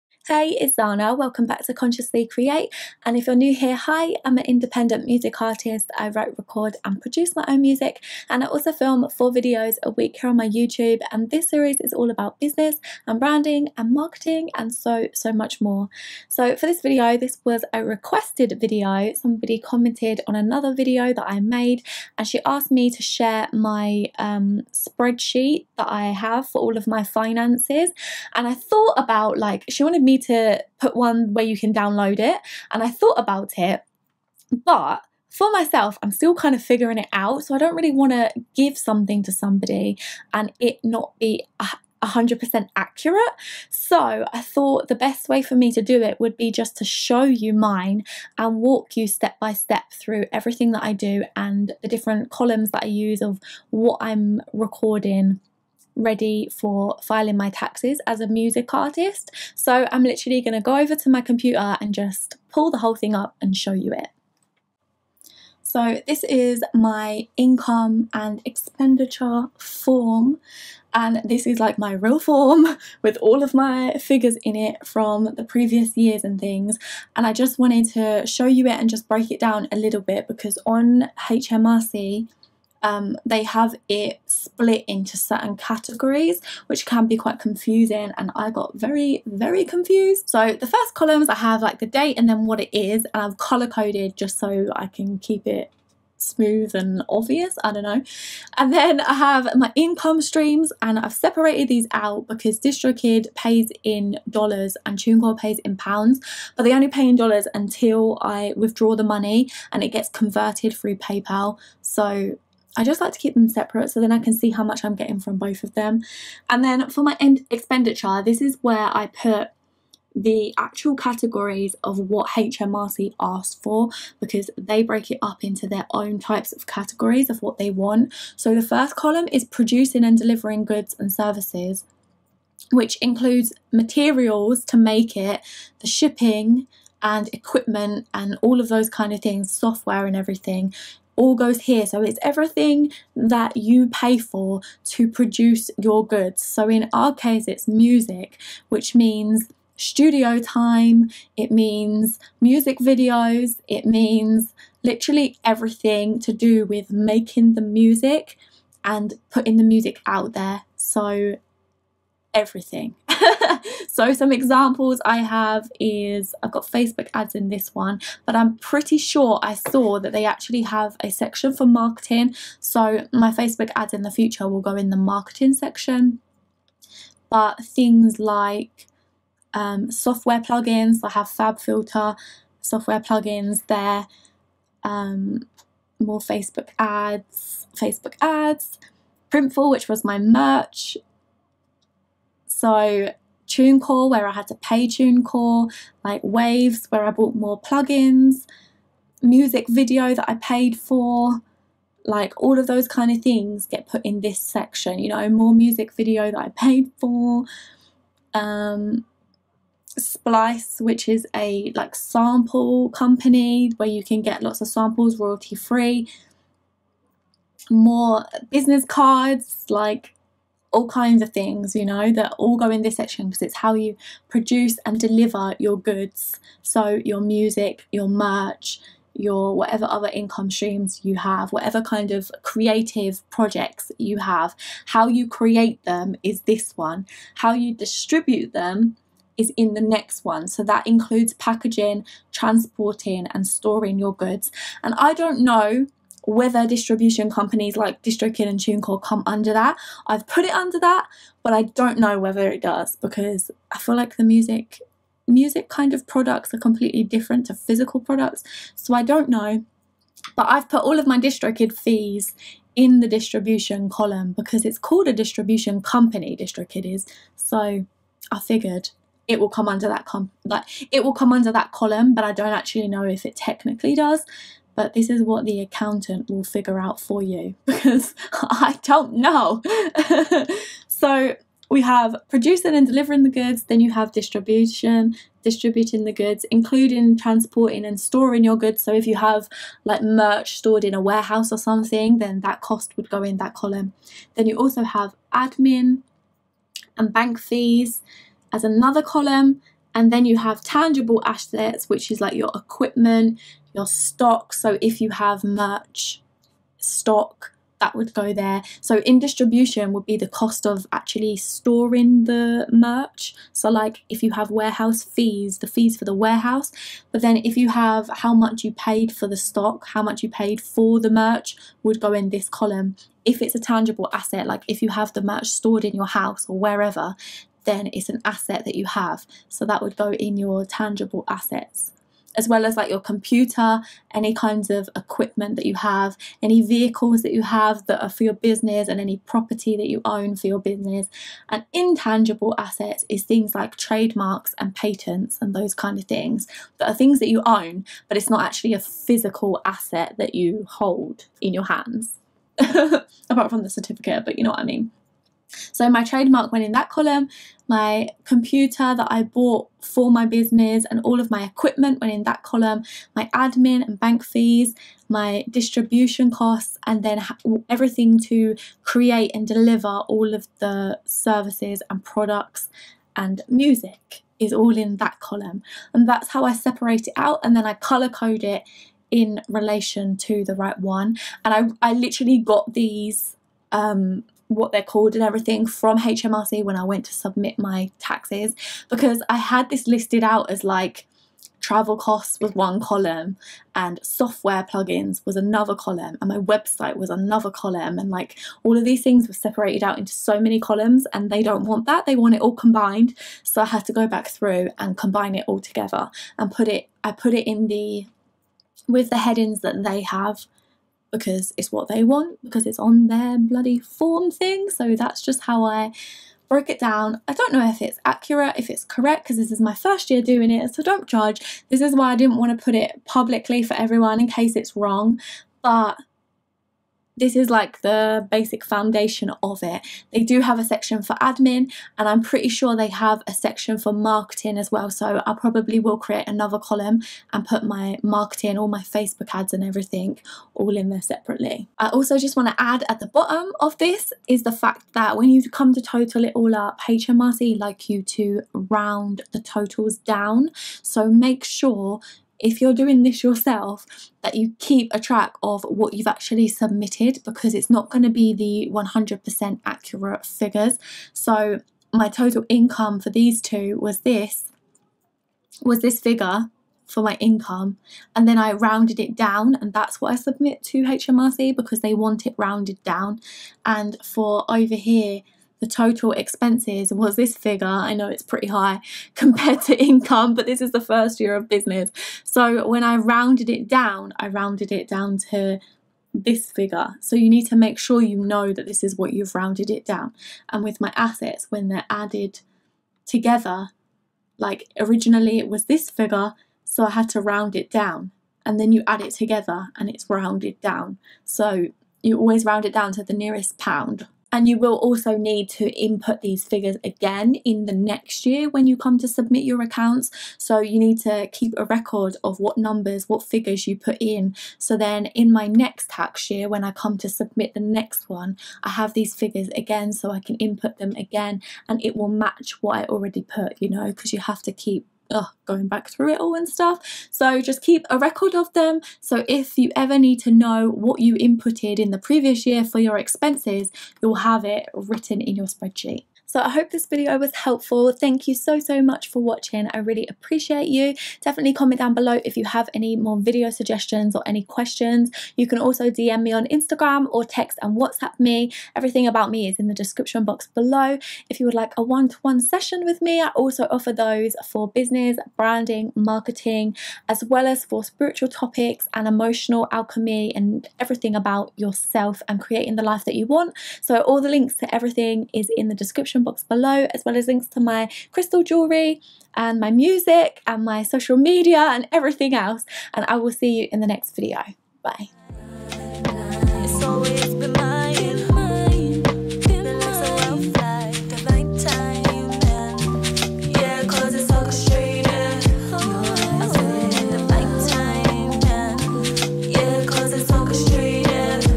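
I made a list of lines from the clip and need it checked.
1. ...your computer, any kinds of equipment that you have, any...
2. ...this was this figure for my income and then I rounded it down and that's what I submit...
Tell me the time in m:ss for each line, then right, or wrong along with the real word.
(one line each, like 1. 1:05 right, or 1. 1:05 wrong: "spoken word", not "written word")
1. 5:32 right
2. 7:44 right.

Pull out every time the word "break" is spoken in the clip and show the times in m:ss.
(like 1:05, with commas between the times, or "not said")
1:19, 2:04.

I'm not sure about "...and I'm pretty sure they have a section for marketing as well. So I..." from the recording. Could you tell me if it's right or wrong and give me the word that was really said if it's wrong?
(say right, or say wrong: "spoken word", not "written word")
right.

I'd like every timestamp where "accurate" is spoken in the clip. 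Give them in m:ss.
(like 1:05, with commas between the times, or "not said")
0:42, 6:58, 7:39.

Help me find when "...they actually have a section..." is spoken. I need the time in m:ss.
2:50.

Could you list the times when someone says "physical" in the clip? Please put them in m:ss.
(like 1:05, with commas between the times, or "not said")
4:17, 5:48.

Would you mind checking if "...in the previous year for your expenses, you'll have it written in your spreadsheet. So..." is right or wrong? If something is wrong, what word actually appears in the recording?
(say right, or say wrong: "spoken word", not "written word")
right.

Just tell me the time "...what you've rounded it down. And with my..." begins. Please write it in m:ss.
8:08.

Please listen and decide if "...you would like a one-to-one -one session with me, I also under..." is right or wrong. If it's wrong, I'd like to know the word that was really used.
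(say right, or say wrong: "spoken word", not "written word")
wrong: "offer", not "under".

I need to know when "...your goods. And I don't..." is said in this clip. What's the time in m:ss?
4:03.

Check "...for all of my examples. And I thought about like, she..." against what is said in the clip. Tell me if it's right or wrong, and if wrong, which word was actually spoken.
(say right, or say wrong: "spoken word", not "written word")
wrong: "finances", not "examples".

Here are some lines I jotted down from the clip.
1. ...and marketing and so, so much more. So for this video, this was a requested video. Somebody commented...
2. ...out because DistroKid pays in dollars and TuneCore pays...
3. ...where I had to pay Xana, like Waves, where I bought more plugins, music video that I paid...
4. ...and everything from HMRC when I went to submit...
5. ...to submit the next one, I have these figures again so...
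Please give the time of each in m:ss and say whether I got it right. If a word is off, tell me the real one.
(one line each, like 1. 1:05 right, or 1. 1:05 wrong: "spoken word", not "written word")
1. 0:13 right
2. 1:41 right
3. 3:14 wrong: "TuneCore", not "Xana"
4. 6:25 right
5. 8:36 right.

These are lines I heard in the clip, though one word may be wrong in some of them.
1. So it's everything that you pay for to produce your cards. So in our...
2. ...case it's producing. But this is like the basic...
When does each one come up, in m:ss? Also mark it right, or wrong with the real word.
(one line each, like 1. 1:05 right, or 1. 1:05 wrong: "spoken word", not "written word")
1. 2:21 wrong: "goods", not "cards"
2. 7:04 wrong: "wrong", not "producing".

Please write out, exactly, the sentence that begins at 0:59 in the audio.
So I'm literally going to go over to my computer and just pull the whole thing up and show you it.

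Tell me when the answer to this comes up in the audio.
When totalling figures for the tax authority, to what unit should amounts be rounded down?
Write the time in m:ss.
8:23.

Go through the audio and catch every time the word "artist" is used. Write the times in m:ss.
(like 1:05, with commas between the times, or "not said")
0:05, 0:58.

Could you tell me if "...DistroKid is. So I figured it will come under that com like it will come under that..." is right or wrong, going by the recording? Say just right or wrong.
right.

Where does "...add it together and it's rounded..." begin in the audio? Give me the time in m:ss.
8:18.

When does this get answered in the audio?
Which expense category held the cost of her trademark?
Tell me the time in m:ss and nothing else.
5:41.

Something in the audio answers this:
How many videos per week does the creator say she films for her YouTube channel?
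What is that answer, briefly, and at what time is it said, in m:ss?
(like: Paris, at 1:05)
4, at 0:09.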